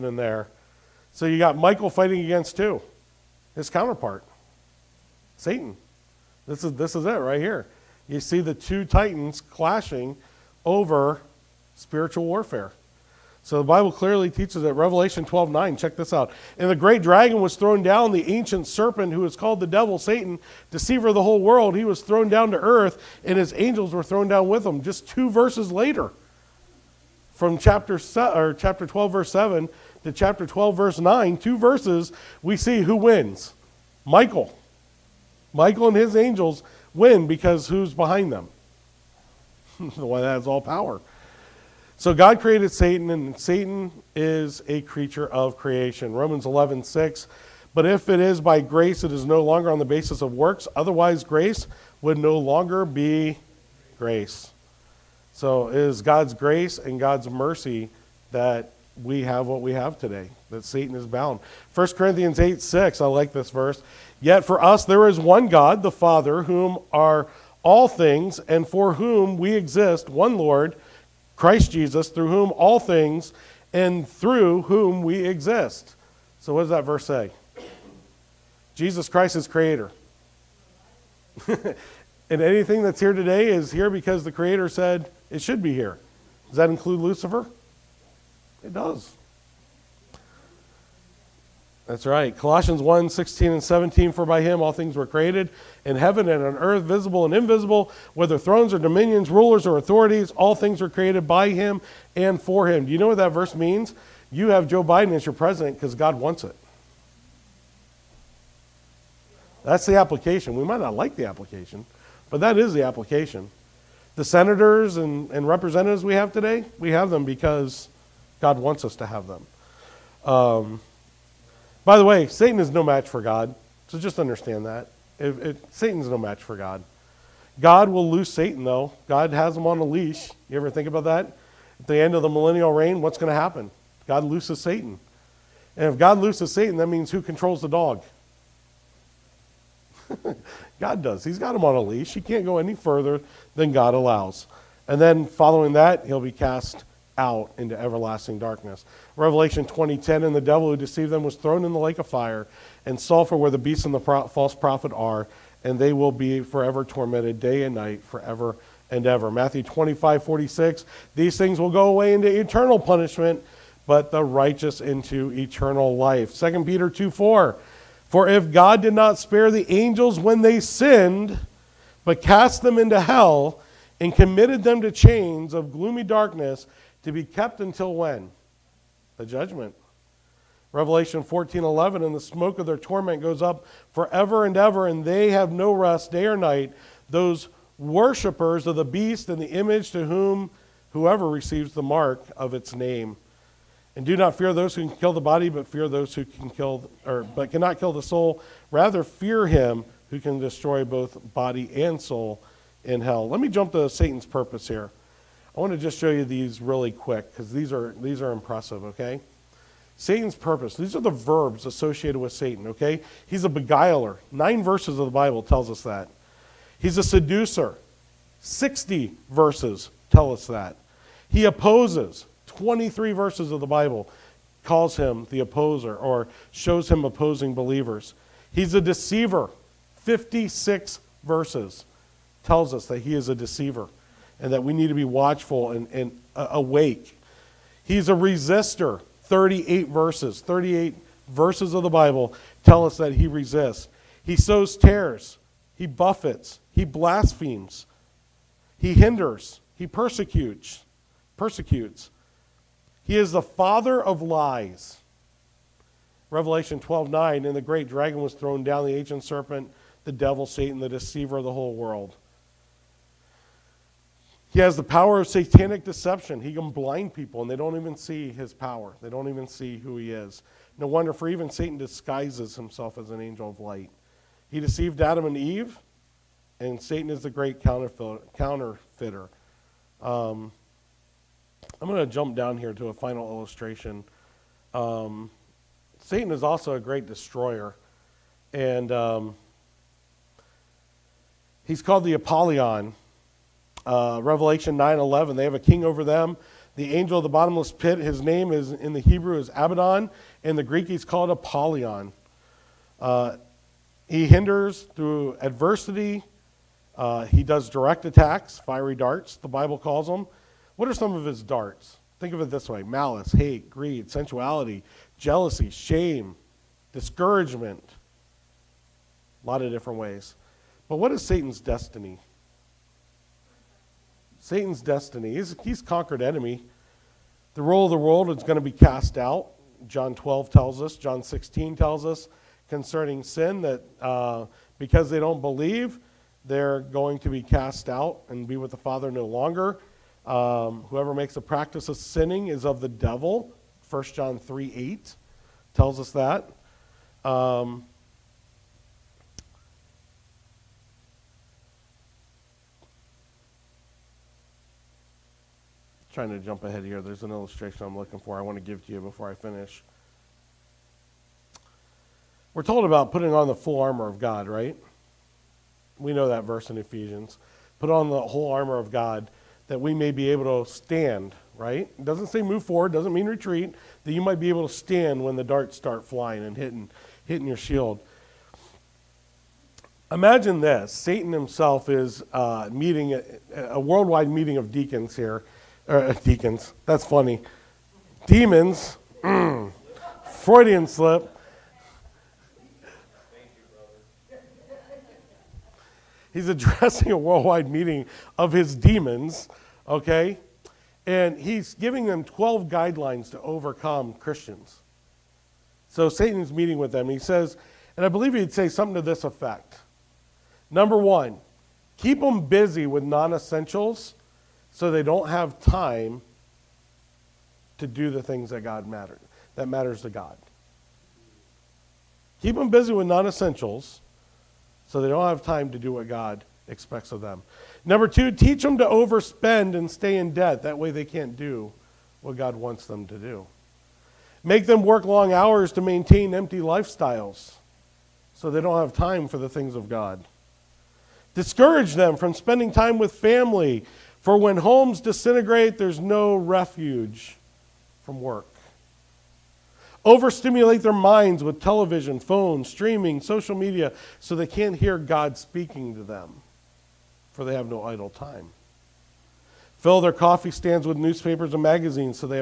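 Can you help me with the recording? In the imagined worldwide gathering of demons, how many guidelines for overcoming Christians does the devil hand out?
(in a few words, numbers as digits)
12.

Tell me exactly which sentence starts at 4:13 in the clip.
He is the father of lies.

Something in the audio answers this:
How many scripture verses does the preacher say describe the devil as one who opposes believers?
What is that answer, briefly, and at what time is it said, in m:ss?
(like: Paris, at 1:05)
23, at 3:42.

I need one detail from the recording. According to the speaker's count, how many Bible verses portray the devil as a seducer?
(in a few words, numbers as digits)
60.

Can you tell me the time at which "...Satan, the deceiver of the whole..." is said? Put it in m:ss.
4:20.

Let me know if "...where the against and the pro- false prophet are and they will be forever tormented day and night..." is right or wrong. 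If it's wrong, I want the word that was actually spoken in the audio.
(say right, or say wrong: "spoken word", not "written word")
wrong: "beast", not "against".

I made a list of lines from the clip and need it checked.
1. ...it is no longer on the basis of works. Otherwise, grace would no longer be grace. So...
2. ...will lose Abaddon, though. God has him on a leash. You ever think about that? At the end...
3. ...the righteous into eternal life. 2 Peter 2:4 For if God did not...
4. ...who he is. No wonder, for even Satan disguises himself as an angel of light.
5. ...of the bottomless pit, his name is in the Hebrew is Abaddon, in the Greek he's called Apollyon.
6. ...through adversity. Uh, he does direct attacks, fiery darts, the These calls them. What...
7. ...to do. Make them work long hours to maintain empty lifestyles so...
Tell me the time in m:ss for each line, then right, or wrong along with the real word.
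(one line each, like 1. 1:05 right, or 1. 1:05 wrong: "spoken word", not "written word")
1. 0:49 right
2. 2:07 wrong: "Satan", not "Abaddon"
3. 2:44 right
4. 4:29 right
5. 4:57 right
6. 5:04 wrong: "Bible", not "These"
7. 7:13 right.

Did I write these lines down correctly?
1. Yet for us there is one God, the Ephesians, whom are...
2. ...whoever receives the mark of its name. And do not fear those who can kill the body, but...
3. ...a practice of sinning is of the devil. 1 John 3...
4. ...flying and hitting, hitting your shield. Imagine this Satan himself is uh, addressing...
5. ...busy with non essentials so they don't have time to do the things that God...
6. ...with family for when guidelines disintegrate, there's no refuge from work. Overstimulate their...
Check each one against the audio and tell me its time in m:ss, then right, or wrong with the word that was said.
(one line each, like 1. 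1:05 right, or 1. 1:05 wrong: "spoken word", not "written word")
1. 1:04 wrong: "Father", not "Ephesians"
2. 3:10 right
3. 5:41 right
4. 6:16 wrong: "meeting", not "addressing"
5. 6:52 right
6. 7:22 wrong: "homes", not "guidelines".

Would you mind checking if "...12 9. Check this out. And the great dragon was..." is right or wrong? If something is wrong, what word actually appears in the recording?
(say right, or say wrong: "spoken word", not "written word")
right.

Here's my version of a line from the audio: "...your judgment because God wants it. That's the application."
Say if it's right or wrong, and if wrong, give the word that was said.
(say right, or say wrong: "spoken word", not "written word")
wrong: "president", not "judgment".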